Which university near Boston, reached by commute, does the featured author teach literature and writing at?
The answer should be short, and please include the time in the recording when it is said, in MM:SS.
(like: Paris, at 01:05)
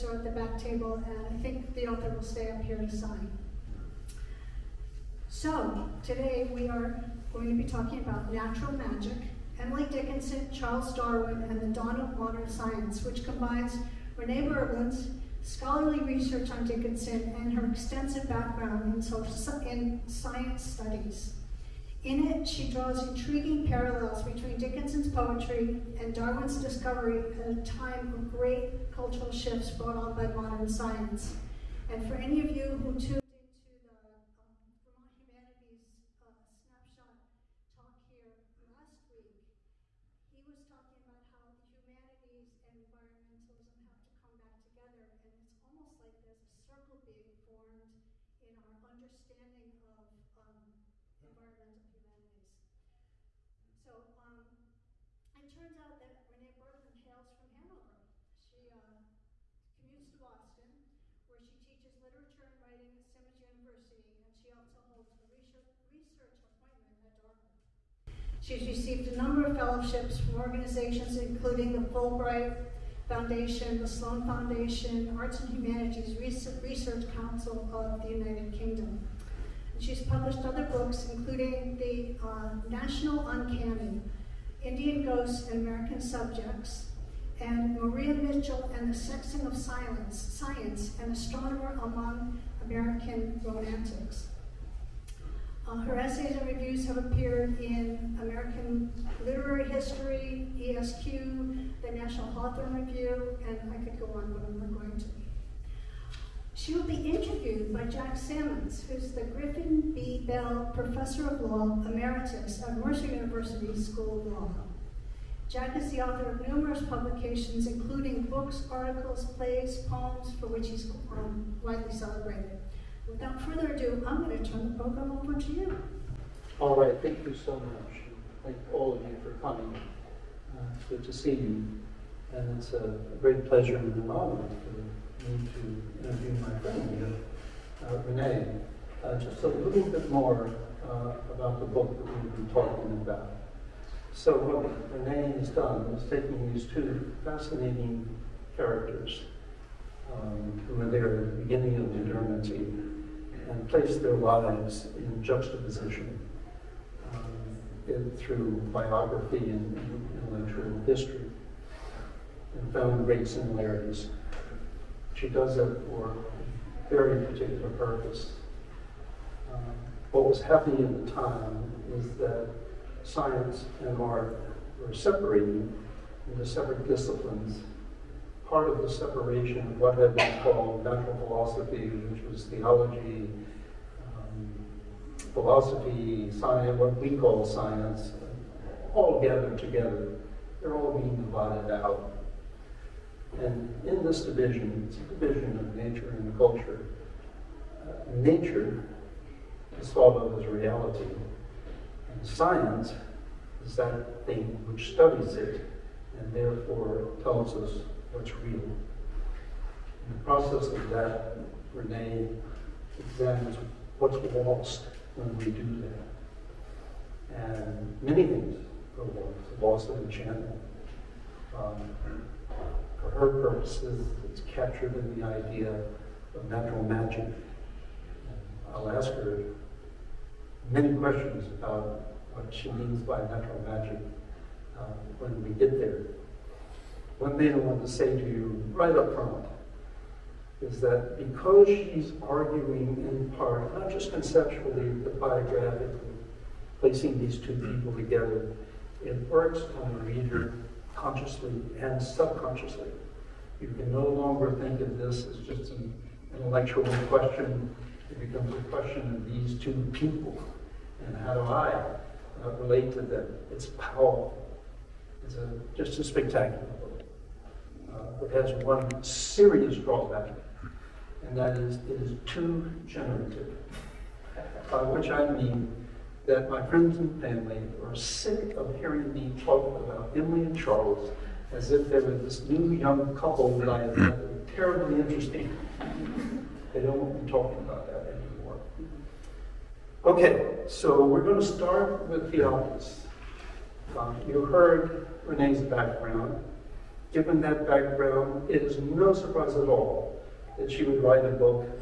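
Simmons University, at 01:03.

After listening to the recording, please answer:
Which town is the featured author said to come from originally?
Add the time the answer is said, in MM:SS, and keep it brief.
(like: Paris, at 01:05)
Hanover, at 00:57.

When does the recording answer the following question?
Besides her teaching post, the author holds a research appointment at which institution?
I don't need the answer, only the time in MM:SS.
01:07.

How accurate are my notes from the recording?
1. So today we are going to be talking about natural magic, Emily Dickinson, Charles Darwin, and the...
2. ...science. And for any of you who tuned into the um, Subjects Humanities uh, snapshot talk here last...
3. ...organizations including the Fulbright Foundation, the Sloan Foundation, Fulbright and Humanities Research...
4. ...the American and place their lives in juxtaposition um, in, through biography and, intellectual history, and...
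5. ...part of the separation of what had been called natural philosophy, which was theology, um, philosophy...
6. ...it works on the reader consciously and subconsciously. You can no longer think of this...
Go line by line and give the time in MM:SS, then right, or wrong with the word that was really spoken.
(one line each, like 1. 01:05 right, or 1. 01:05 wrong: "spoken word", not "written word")
1. 00:05 right
2. 00:30 wrong: "Vermont", not "Subjects"
3. 01:10 wrong: "Arts", not "Fulbright"
4. 02:31 wrong: "Durmancy", not "American"
5. 02:58 right
6. 04:09 right.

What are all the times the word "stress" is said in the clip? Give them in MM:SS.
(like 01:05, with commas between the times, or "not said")
not said.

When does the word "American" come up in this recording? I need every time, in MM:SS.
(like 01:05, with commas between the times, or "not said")
01:25, 01:32, 01:38.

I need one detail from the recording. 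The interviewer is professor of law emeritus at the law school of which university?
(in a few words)
Mercer University.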